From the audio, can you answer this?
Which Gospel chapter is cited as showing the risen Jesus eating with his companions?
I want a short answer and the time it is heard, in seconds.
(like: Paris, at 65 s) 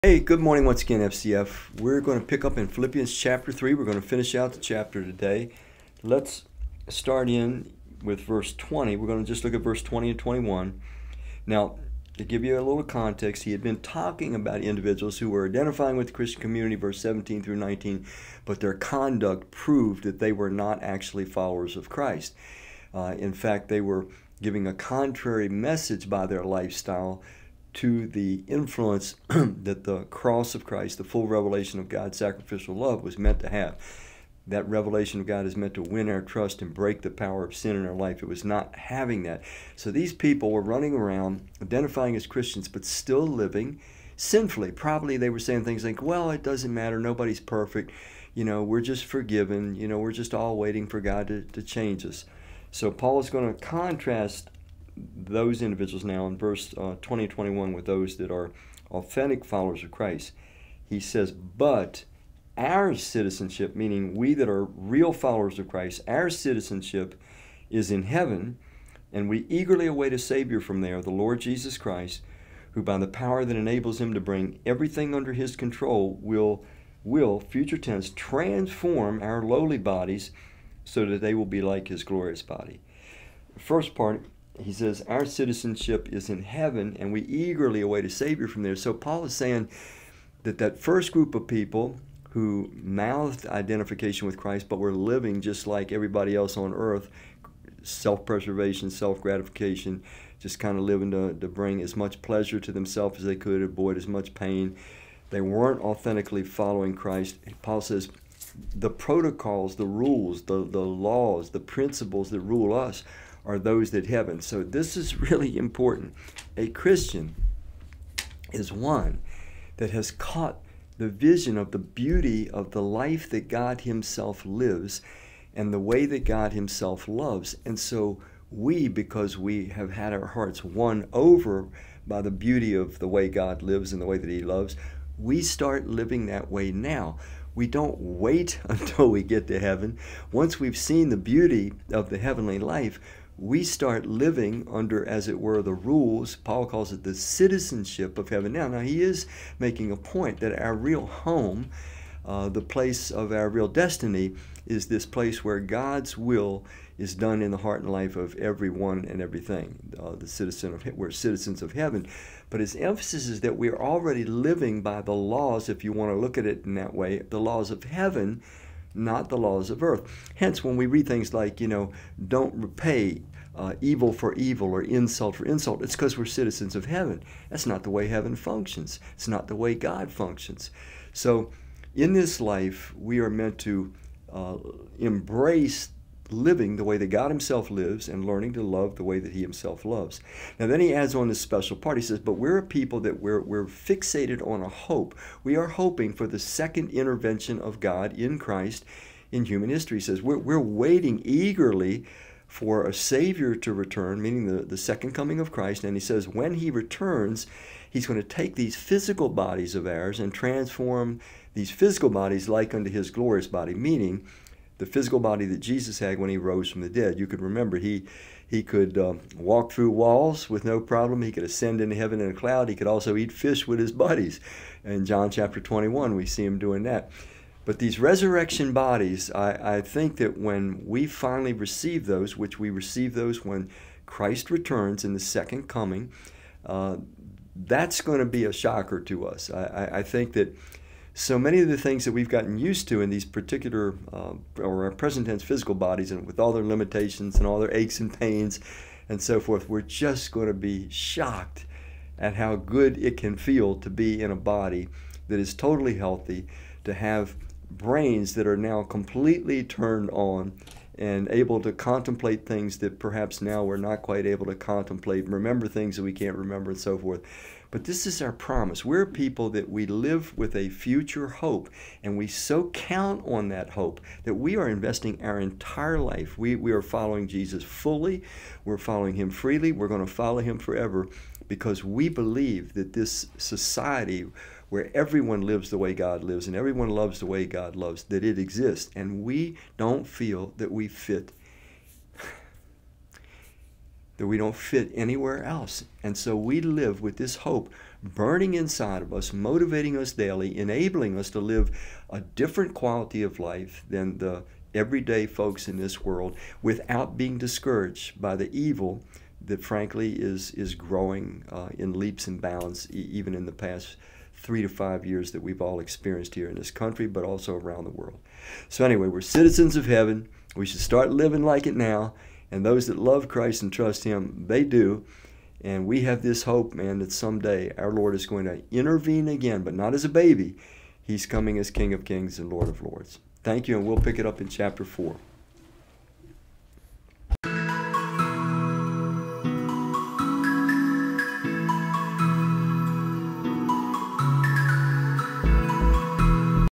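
John 21, at 225 s.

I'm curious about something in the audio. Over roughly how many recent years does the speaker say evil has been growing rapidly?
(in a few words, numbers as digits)
3 to 5 years.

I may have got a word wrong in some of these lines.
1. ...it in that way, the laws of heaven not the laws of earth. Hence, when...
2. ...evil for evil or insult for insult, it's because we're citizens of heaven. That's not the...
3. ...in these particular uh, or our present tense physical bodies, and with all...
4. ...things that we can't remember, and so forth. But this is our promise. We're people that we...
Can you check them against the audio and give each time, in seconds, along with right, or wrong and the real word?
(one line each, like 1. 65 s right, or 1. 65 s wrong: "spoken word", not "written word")
1. 166 s right
2. 173 s right
3. 243 s right
4. 265 s right.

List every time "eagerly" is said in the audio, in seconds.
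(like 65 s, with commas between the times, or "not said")
69 s, 87 s, 201 s.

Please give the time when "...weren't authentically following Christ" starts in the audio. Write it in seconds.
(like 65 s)
105 s.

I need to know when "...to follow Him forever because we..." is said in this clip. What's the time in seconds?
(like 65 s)
280 s.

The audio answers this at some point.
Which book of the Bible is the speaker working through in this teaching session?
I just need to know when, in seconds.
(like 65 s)
2 s.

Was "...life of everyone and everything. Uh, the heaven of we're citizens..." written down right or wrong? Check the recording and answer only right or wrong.
wrong.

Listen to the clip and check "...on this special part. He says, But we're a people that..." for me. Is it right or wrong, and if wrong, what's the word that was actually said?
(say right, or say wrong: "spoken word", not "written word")
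right.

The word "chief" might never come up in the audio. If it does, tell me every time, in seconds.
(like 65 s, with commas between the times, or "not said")
not said.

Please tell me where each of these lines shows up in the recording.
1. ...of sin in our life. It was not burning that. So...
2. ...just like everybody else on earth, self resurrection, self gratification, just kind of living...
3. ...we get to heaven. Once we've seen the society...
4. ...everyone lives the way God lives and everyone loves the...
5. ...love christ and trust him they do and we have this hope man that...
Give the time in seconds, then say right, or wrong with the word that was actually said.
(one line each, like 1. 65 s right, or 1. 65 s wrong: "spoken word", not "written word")
1. 37 s wrong: "having", not "burning"
2. 95 s wrong: "preservation", not "resurrection"
3. 139 s wrong: "beauty", not "society"
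4. 284 s right
5. 322 s right.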